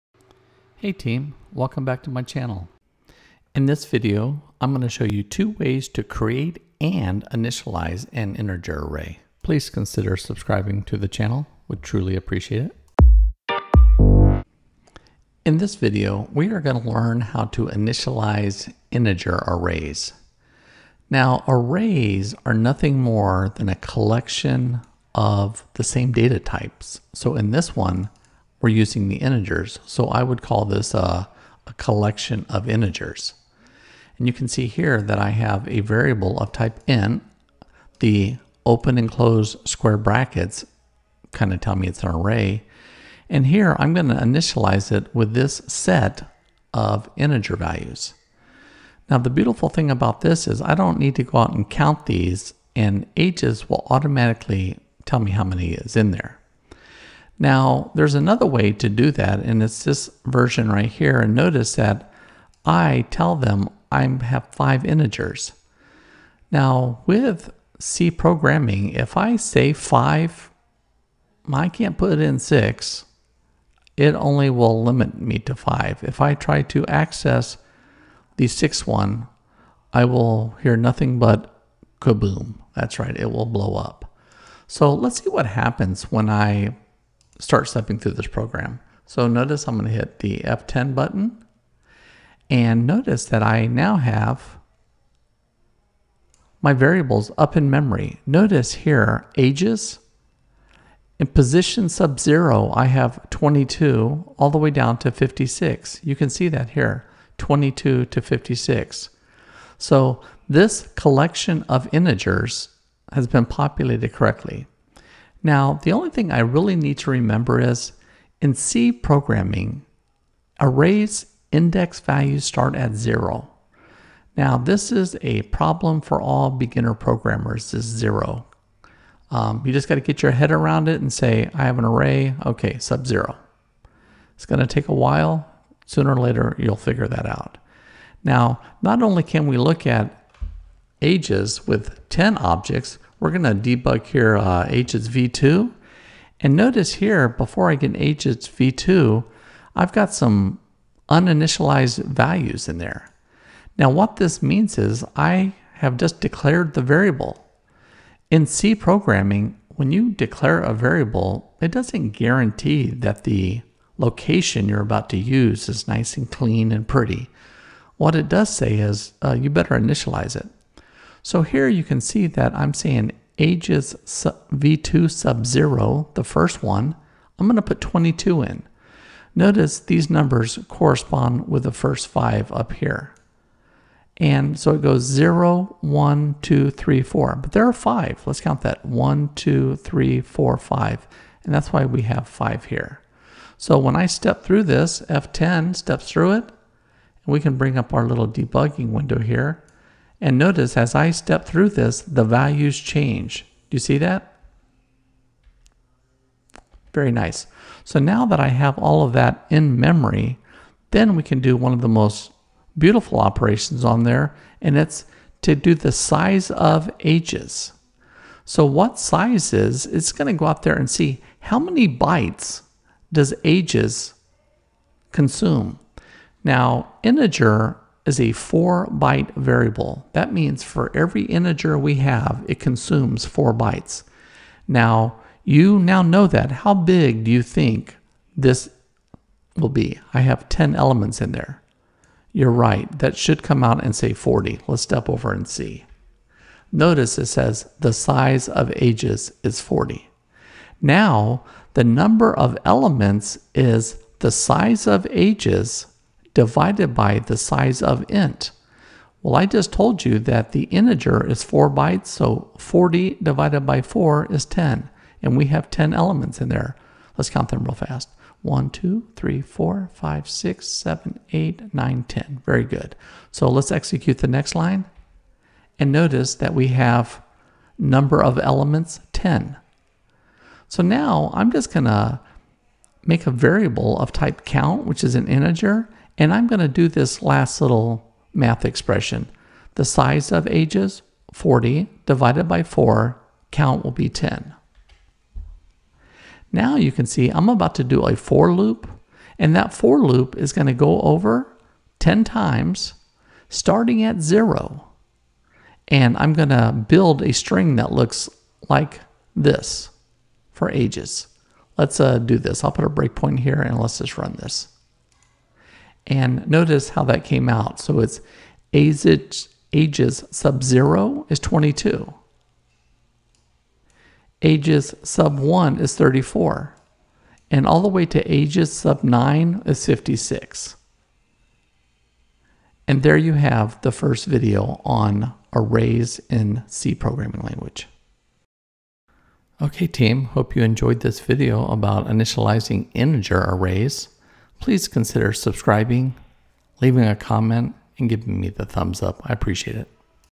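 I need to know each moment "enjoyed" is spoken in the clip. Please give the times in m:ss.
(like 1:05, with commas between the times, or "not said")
5:40.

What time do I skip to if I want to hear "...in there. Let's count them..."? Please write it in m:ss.
4:26.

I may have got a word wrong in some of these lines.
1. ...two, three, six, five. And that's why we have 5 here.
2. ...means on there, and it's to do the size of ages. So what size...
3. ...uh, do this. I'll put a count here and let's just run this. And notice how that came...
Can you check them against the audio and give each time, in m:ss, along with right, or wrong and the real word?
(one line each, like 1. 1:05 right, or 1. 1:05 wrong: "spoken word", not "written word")
1. 3:09 wrong: "four", not "six"
2. 3:33 wrong: "operations", not "means"
3. 5:11 wrong: "breakpoint", not "count".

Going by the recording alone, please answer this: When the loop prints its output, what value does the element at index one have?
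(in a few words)
34.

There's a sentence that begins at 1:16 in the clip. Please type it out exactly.
If I try to access the sixth one, I will hear nothing but kaboom.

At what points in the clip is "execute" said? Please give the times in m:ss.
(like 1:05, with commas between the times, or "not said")
4:33.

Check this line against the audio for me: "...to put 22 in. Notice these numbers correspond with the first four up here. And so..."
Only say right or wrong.
wrong.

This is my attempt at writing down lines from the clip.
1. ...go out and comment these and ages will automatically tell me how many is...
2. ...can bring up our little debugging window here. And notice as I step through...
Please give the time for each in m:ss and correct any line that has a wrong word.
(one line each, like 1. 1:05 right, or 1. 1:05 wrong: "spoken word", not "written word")
1. 0:51 wrong: "count", not "comment"
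2. 3:17 right.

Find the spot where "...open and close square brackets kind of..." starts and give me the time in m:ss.
0:38.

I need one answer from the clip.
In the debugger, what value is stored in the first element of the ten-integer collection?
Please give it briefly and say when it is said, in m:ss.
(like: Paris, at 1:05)
22, at 1:42.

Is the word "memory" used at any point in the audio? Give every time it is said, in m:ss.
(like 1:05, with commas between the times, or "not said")
1:37, 3:29.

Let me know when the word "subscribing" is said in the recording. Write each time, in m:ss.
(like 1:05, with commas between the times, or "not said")
0:10, 5:45.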